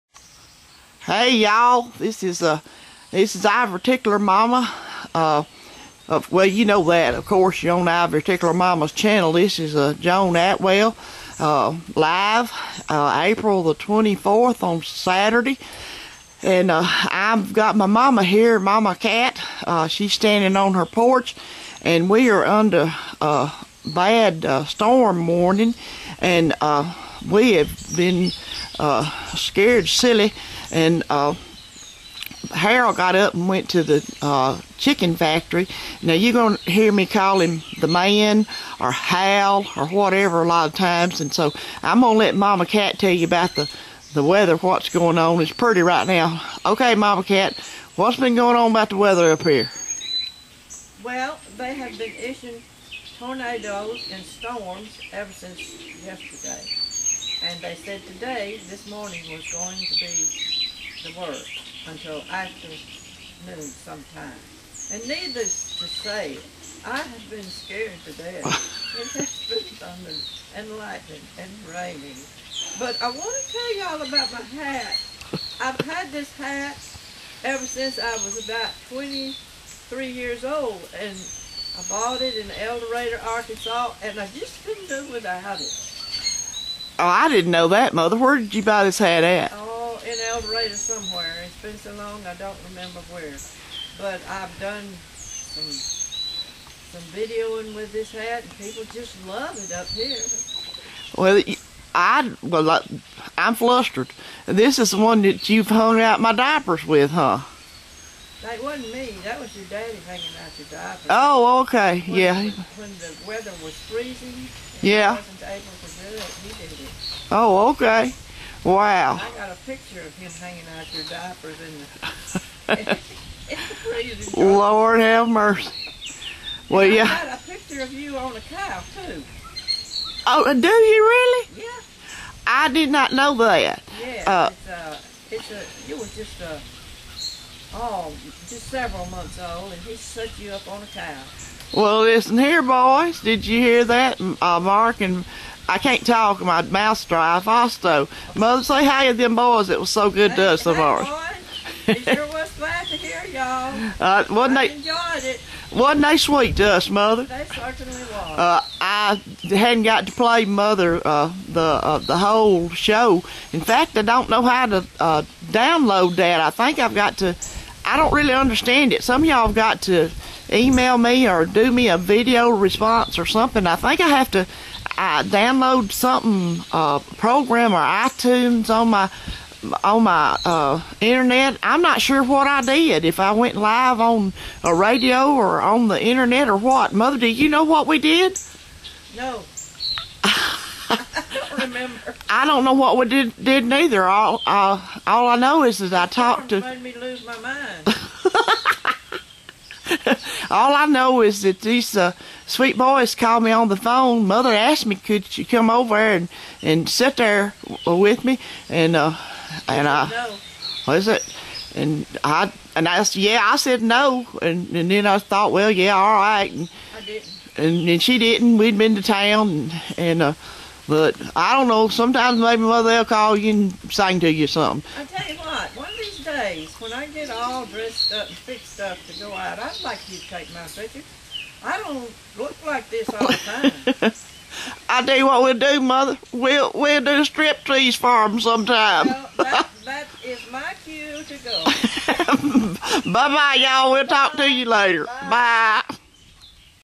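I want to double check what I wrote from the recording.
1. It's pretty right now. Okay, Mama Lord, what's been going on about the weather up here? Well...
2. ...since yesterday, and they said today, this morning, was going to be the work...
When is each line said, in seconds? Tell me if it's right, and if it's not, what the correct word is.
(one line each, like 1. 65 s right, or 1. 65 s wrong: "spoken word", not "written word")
1. 45 s wrong: "Kat", not "Lord"
2. 55 s right.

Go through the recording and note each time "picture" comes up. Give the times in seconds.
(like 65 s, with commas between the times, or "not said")
119 s, 127 s, 230 s.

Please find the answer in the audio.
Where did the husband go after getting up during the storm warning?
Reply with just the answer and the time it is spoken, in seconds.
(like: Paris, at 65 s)
chicken factory, at 34 s.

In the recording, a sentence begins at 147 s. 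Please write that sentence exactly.
Fausto, mother, say hi to them boys.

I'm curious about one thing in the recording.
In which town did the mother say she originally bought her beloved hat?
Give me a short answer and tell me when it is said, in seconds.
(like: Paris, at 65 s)
El Dorado, Arkansas, at 82 s.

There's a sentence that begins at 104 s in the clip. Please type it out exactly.
This is the one that you've hung out my diapers with, huh?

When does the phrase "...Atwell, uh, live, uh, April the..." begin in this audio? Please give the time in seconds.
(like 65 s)
10 s.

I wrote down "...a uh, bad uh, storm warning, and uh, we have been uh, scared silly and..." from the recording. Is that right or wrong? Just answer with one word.
right.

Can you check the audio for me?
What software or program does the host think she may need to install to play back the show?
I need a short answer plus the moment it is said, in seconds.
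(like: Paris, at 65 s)
iTunes, at 177 s.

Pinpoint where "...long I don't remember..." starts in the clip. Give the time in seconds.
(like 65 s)
91 s.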